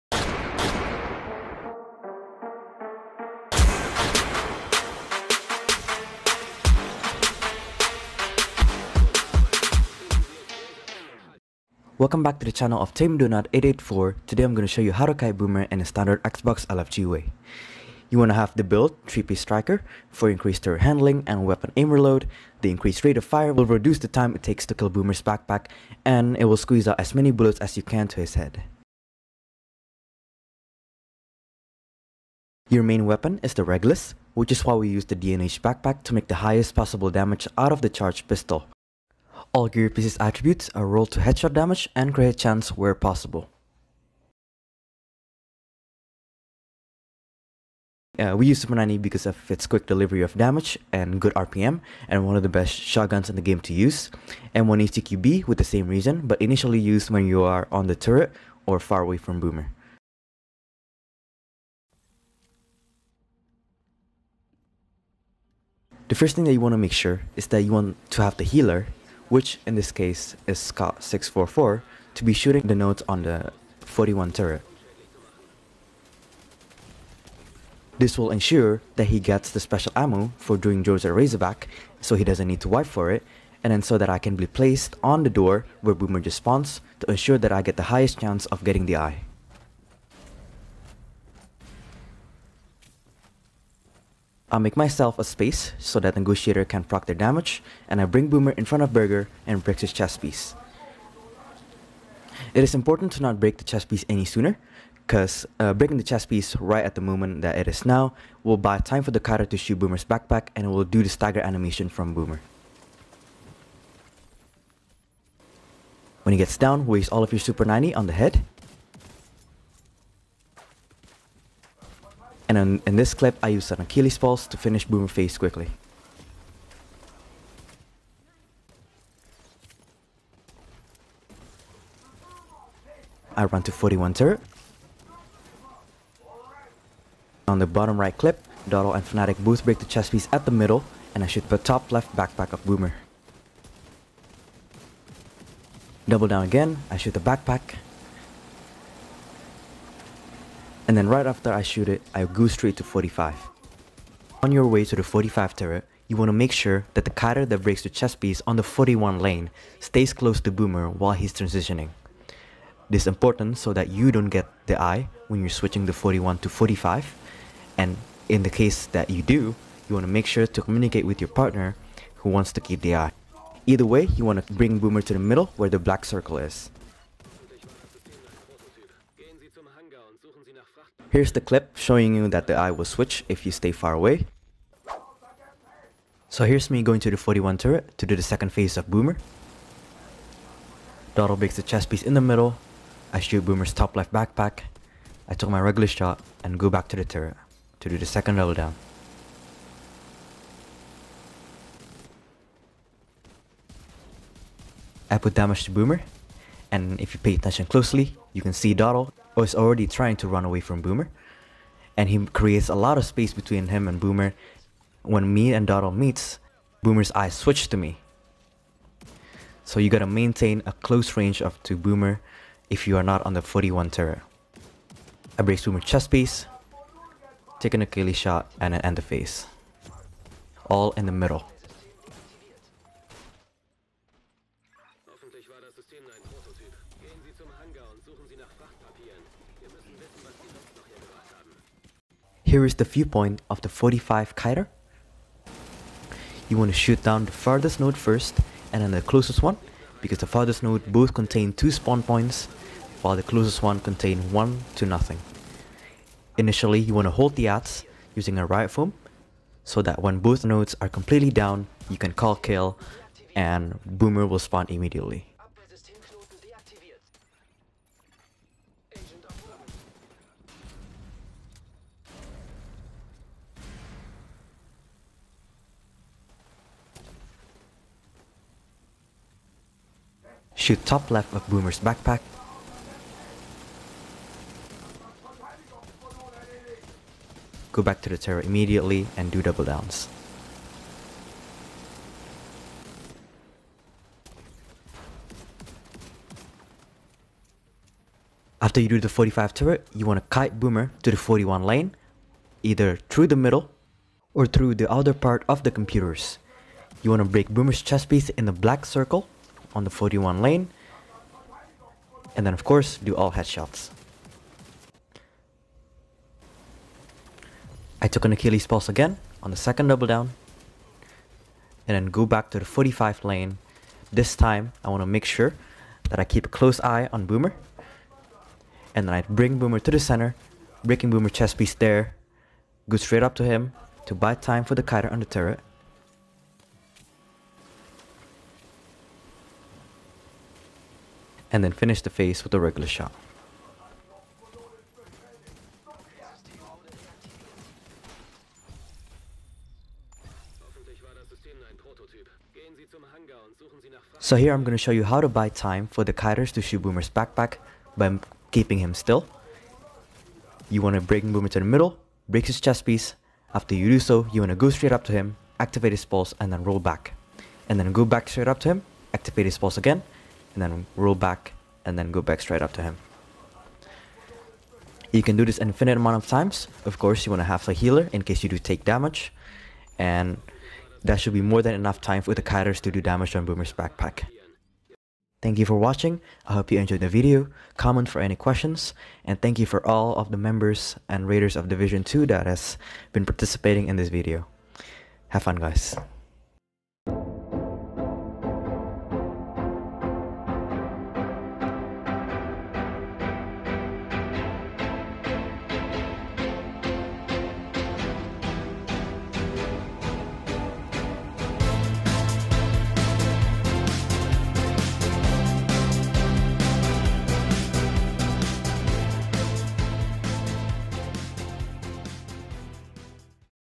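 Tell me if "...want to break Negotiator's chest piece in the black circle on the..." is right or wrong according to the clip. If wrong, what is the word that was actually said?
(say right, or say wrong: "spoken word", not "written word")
wrong: "Boomer", not "Negotiator".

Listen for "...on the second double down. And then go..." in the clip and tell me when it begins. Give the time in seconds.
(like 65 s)
319 s.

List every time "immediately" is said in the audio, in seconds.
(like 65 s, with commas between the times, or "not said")
264 s, 288 s.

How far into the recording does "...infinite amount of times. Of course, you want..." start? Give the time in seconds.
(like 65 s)
375 s.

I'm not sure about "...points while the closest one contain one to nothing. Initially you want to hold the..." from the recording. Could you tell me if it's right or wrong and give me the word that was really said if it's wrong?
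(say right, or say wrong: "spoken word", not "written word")
right.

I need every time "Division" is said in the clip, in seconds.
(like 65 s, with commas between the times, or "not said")
391 s.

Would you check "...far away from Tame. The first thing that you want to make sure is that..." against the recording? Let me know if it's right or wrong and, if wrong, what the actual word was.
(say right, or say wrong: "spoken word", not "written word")
wrong: "Boomer", not "Tame".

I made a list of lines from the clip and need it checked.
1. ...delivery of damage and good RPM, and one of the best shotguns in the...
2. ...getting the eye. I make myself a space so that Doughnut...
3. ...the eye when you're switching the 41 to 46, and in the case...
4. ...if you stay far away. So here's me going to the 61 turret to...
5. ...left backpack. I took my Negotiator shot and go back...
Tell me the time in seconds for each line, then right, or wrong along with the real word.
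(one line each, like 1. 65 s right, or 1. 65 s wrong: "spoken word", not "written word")
1. 49 s right
2. 88 s wrong: "Negotiator", not "Doughnut"
3. 164 s wrong: "45", not "46"
4. 183 s wrong: "41", not "61"
5. 193 s wrong: "Regulus", not "Negotiator".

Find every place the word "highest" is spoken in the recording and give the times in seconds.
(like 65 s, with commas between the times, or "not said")
36 s, 87 s.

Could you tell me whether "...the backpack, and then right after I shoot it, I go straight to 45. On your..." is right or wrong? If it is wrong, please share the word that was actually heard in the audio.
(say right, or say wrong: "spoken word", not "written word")
right.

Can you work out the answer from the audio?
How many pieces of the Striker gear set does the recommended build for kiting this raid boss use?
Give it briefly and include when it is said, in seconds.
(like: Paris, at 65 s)
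3, at 19 s.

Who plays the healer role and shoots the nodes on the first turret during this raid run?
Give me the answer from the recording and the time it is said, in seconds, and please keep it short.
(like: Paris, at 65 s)
Scott 644, at 70 s.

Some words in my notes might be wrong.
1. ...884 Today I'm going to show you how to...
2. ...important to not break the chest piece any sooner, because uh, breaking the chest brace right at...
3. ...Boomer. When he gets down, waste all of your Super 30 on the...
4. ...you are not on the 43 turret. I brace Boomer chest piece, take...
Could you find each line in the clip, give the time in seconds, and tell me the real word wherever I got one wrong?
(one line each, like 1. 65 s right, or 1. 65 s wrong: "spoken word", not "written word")
1. 13 s right
2. 102 s wrong: "piece", not "brace"
3. 112 s wrong: "90", not "30"
4. 222 s wrong: "41", not "43".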